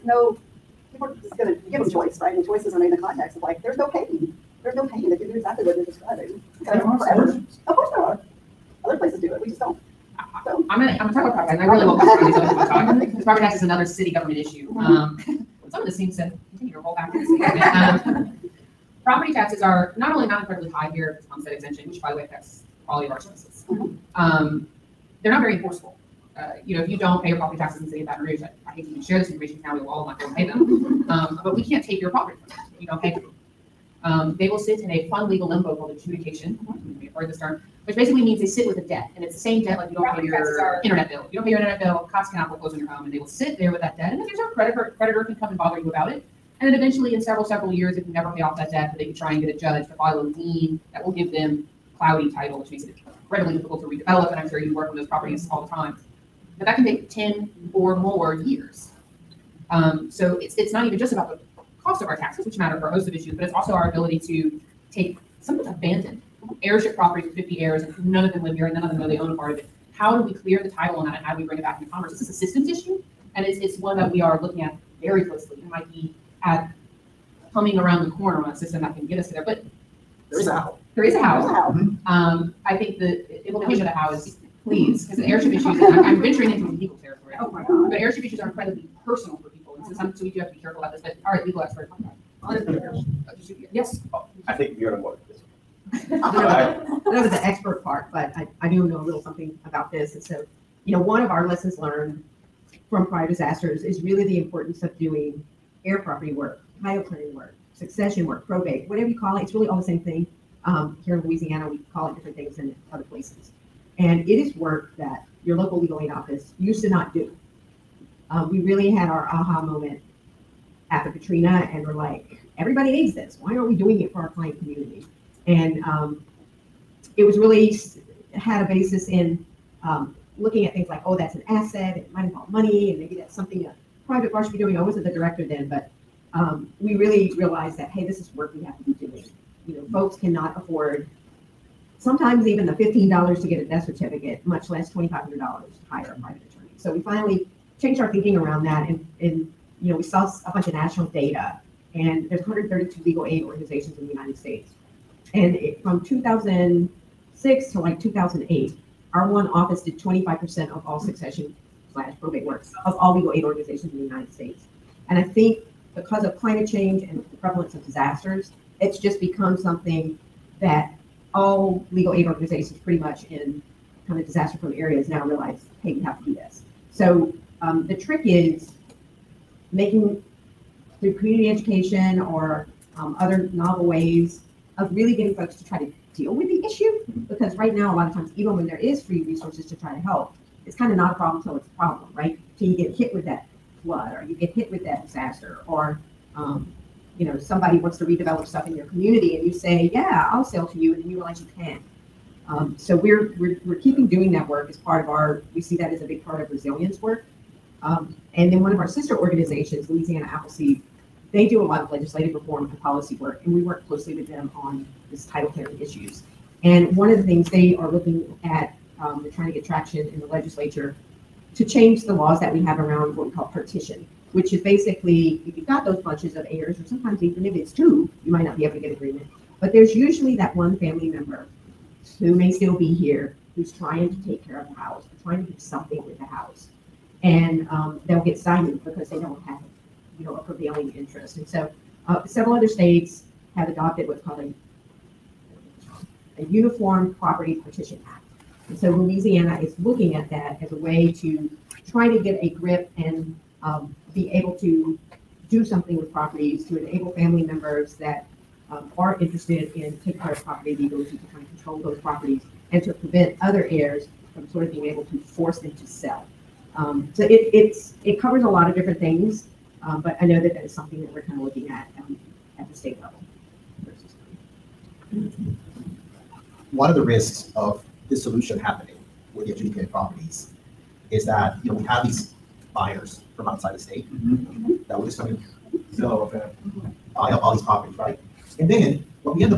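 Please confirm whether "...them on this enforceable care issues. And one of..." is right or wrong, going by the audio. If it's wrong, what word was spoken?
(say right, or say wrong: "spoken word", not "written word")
wrong: "title", not "enforceable".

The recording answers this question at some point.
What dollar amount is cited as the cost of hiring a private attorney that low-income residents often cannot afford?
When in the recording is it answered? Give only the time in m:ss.
2:24.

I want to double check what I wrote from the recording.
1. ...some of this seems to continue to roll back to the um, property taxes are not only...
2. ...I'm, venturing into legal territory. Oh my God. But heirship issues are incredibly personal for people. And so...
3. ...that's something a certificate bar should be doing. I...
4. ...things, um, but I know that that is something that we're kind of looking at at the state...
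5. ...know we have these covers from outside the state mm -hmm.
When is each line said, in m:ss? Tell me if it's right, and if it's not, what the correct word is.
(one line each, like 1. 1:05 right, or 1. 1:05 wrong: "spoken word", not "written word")
1. 0:15 right
2. 1:26 right
3. 2:13 wrong: "private", not "certificate"
4. 4:28 right
5. 4:41 wrong: "buyers", not "covers".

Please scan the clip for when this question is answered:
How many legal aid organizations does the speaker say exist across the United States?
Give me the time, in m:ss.
2:32.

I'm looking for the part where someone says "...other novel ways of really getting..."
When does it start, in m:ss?
3:03.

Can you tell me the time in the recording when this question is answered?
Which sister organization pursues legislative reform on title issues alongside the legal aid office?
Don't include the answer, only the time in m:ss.
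3:29.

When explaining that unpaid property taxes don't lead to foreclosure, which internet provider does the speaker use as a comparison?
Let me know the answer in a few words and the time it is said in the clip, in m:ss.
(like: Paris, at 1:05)
Cox, at 0:42.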